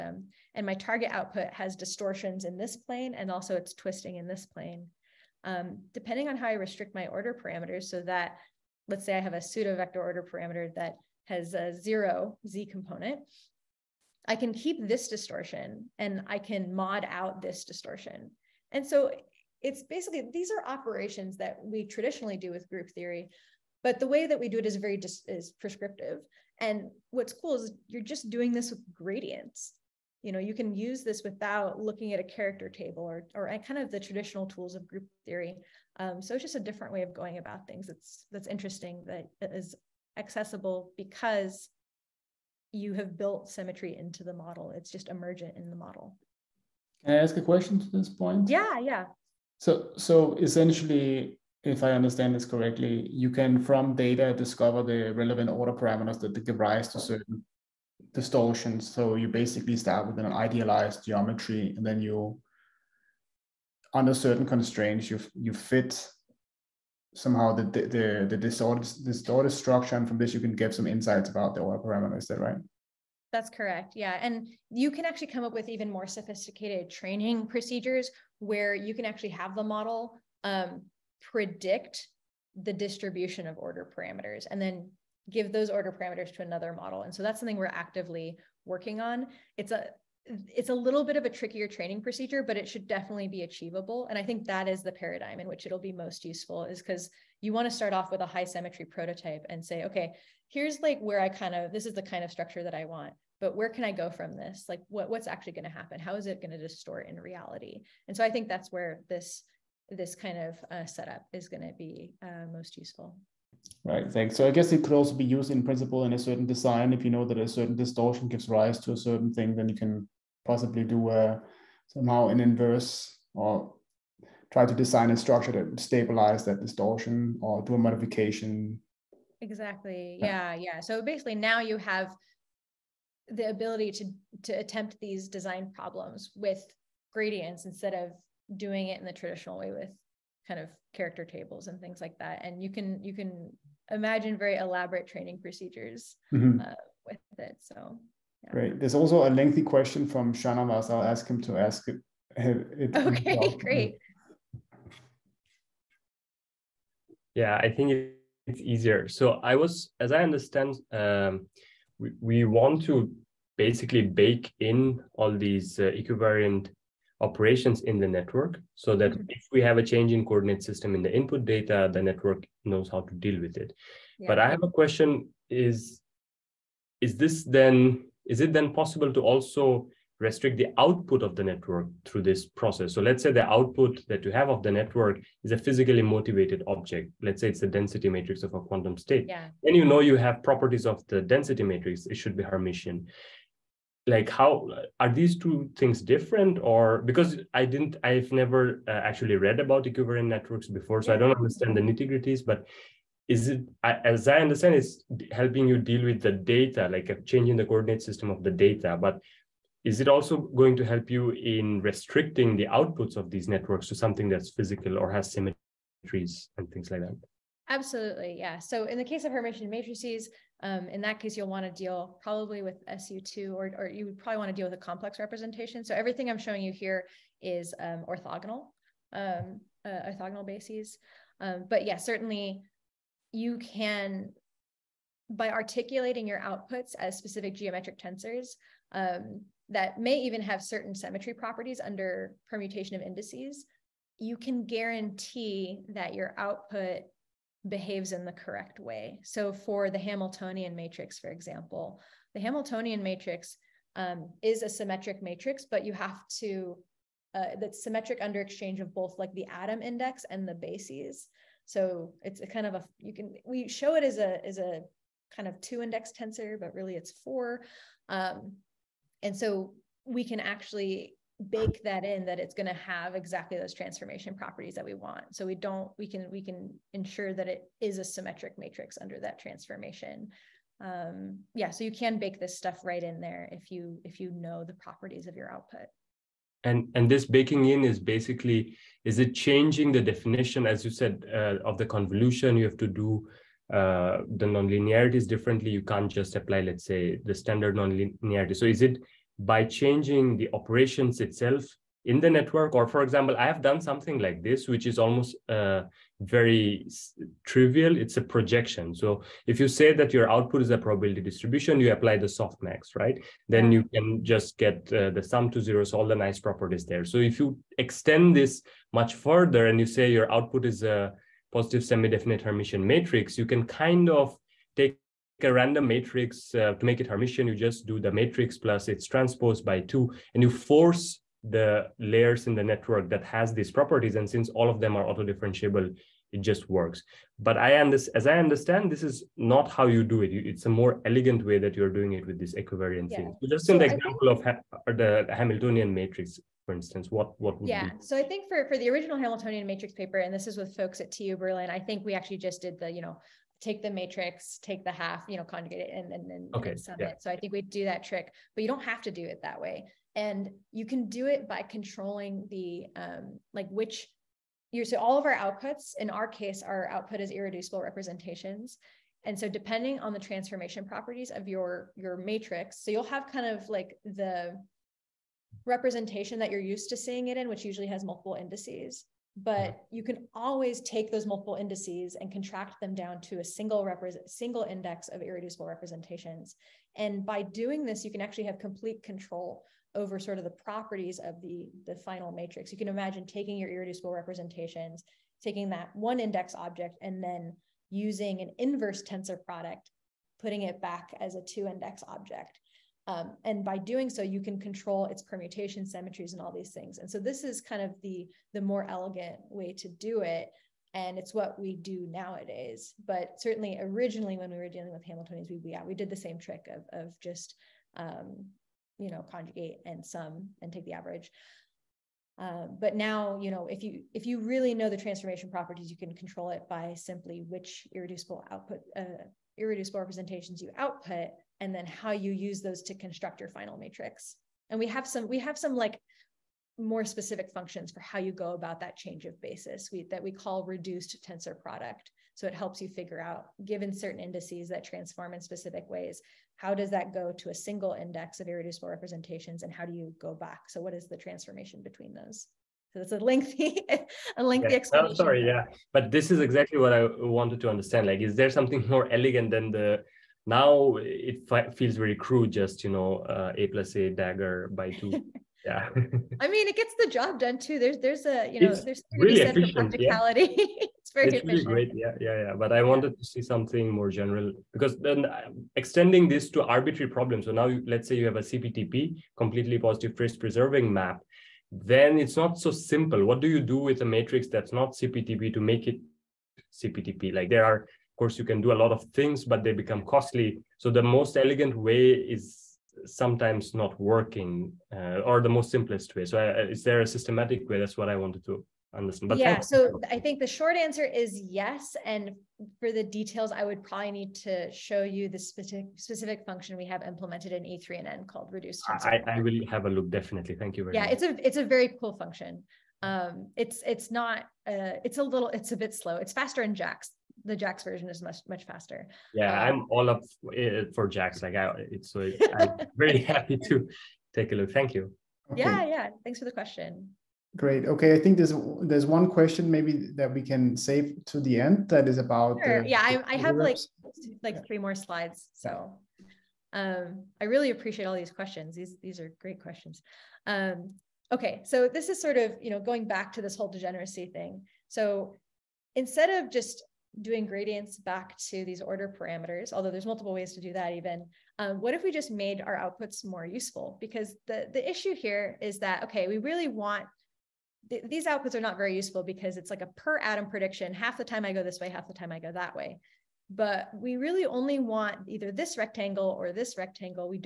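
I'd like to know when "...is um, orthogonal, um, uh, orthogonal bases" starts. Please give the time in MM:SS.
03:47.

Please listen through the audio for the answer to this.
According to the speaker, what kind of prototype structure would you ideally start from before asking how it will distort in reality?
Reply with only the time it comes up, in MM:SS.
01:38.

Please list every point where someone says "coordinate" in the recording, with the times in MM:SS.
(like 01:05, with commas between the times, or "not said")
02:50, 03:27.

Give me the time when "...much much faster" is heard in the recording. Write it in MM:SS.
08:38.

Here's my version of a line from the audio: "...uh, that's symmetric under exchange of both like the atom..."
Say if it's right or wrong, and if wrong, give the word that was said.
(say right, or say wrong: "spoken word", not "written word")
right.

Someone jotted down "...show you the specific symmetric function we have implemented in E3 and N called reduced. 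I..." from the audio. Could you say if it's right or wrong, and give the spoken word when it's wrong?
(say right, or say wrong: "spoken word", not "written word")
wrong: "specific", not "symmetric".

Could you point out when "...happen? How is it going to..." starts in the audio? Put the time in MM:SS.
01:45.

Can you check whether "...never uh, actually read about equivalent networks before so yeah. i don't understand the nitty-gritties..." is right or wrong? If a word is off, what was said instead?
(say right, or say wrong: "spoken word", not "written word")
right.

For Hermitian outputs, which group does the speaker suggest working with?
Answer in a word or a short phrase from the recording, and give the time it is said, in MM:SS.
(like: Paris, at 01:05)
SU2, at 03:42.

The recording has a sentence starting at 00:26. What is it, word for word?
And what's cool is you're just doing this with gradients.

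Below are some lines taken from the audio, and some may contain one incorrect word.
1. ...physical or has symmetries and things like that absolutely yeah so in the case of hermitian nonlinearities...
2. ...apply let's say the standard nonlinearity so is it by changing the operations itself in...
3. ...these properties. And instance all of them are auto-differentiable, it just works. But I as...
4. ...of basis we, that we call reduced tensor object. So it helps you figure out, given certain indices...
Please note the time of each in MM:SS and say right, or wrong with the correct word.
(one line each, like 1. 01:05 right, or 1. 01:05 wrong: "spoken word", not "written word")
1. 03:34 wrong: "matrices", not "nonlinearities"
2. 04:56 right
3. 05:33 wrong: "since", not "instance"
4. 07:19 wrong: "product", not "object".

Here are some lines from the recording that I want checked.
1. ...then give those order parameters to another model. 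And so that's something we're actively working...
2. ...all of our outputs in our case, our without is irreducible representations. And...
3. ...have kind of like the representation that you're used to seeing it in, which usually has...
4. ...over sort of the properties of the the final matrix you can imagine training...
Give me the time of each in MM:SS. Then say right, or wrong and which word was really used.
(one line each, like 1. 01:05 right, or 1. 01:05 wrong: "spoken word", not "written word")
1. 01:24 right
2. 06:04 wrong: "output", not "without"
3. 06:13 right
4. 06:29 wrong: "taking", not "training".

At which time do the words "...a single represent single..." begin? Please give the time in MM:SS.
06:23.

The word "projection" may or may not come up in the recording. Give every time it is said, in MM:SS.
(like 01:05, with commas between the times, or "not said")
05:08.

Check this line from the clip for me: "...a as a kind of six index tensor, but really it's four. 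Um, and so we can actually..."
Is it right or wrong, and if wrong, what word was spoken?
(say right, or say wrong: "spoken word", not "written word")
wrong: "two", not "six".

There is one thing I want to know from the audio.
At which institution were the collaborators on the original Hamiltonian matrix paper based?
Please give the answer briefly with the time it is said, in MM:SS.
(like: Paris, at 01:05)
TU Berlin, at 05:51.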